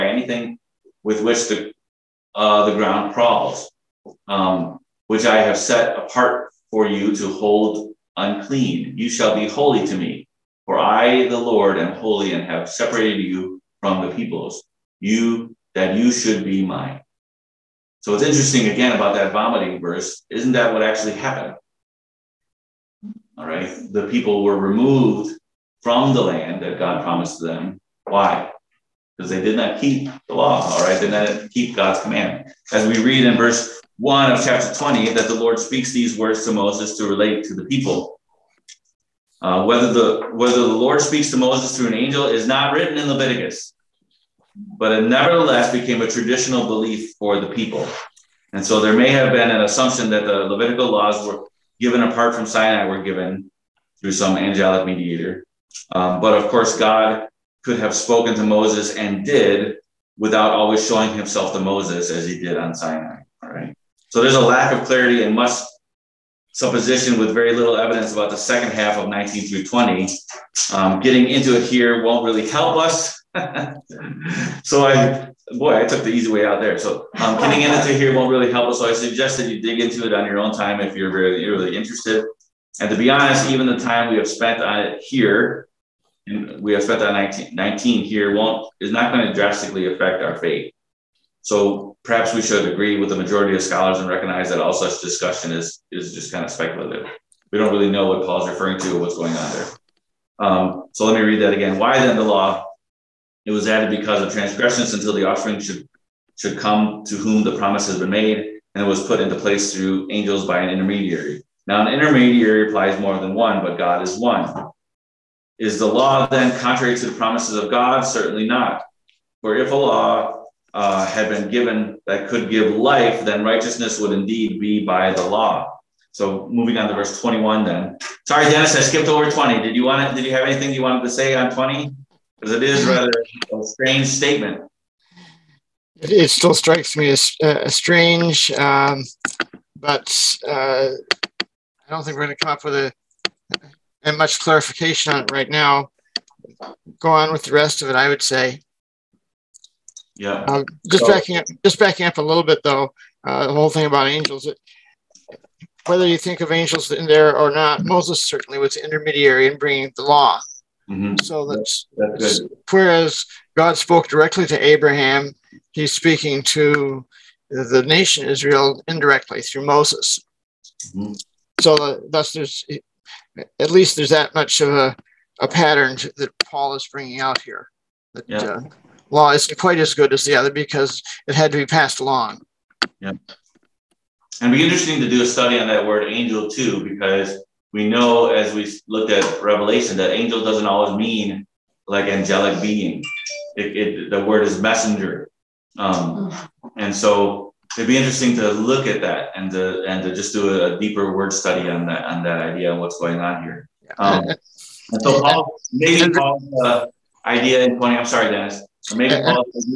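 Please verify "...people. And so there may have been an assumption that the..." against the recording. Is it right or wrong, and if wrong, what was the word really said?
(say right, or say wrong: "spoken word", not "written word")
right.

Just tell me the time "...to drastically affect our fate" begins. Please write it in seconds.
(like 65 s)
89 s.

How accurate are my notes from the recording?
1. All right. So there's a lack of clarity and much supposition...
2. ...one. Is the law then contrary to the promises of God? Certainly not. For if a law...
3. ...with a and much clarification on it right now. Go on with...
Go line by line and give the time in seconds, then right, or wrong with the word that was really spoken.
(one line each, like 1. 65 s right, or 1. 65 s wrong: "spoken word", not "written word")
1. 63 s right
2. 114 s right
3. 142 s right.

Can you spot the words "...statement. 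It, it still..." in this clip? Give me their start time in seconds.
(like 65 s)
134 s.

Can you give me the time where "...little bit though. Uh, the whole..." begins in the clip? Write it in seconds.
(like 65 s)
152 s.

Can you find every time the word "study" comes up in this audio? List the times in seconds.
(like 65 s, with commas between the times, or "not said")
185 s, 201 s.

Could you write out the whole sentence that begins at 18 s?
So it's interesting again about that vomiting verse.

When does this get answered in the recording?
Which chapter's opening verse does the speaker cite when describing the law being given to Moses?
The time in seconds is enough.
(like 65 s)
34 s.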